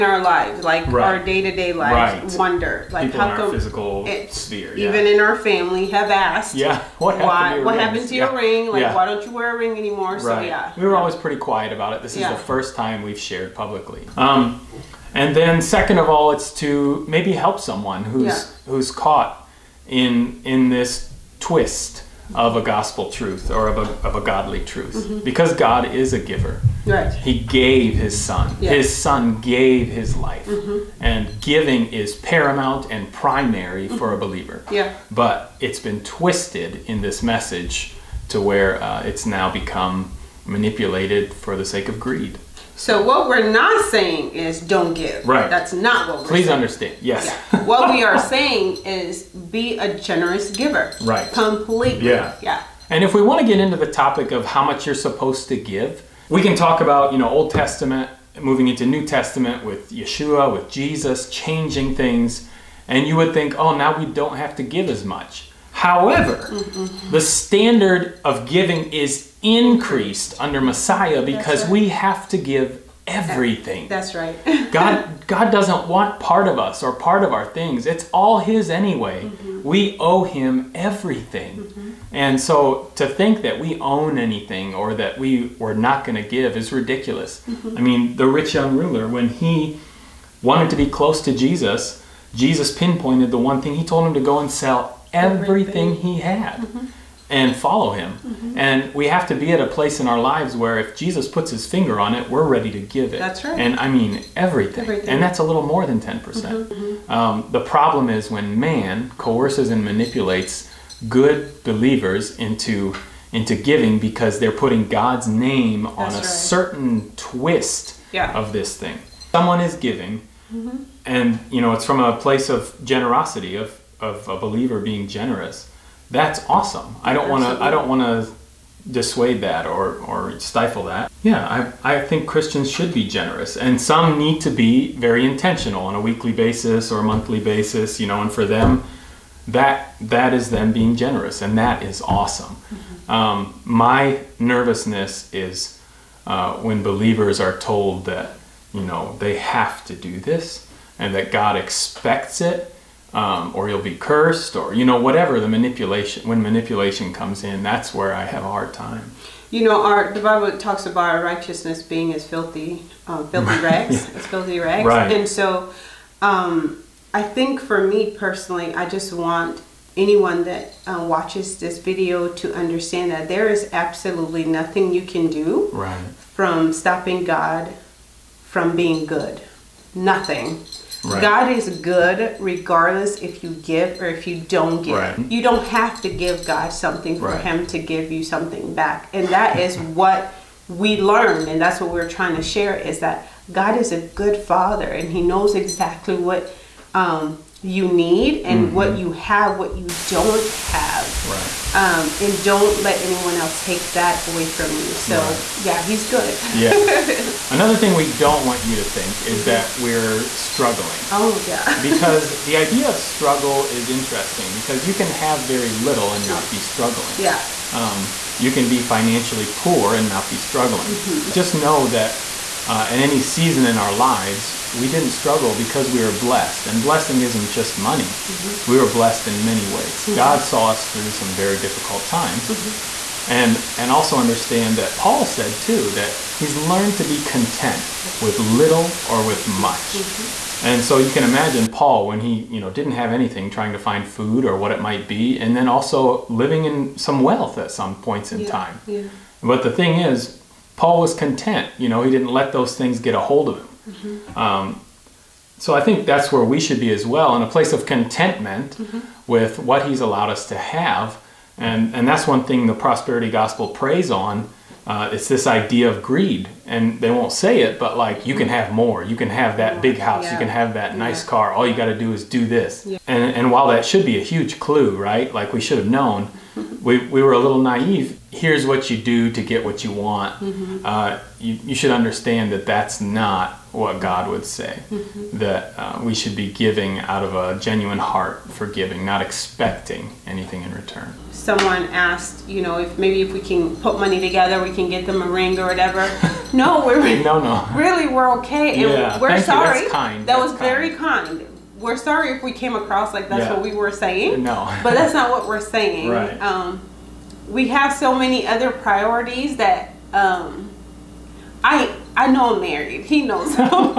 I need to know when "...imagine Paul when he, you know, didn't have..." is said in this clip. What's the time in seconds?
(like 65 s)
241 s.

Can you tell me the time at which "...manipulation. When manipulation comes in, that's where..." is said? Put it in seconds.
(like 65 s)
155 s.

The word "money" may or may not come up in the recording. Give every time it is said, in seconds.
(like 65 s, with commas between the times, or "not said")
227 s, 293 s.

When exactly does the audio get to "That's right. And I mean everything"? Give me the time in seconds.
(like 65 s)
103 s.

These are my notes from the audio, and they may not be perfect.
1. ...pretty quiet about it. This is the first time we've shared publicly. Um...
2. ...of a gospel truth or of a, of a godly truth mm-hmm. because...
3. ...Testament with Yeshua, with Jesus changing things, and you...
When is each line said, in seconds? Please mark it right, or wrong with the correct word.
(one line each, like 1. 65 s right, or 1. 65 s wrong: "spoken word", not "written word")
1. 11 s right
2. 22 s right
3. 59 s right.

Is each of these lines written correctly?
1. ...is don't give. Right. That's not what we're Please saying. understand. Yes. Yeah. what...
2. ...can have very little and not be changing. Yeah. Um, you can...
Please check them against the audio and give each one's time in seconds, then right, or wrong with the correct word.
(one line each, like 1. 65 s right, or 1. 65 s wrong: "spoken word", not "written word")
1. 44 s right
2. 214 s wrong: "struggling", not "changing".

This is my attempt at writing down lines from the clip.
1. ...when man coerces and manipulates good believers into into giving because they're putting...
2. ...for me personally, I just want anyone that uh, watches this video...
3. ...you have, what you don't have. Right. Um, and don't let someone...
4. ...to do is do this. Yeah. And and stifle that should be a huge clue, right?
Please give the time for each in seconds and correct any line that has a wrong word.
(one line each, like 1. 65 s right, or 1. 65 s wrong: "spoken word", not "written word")
1. 108 s right
2. 167 s right
3. 198 s wrong: "anyone", not "someone"
4. 271 s wrong: "while", not "stifle".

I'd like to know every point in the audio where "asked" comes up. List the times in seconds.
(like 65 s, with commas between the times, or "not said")
6 s, 291 s.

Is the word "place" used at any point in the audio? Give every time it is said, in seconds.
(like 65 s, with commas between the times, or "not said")
99 s, 122 s, 257 s.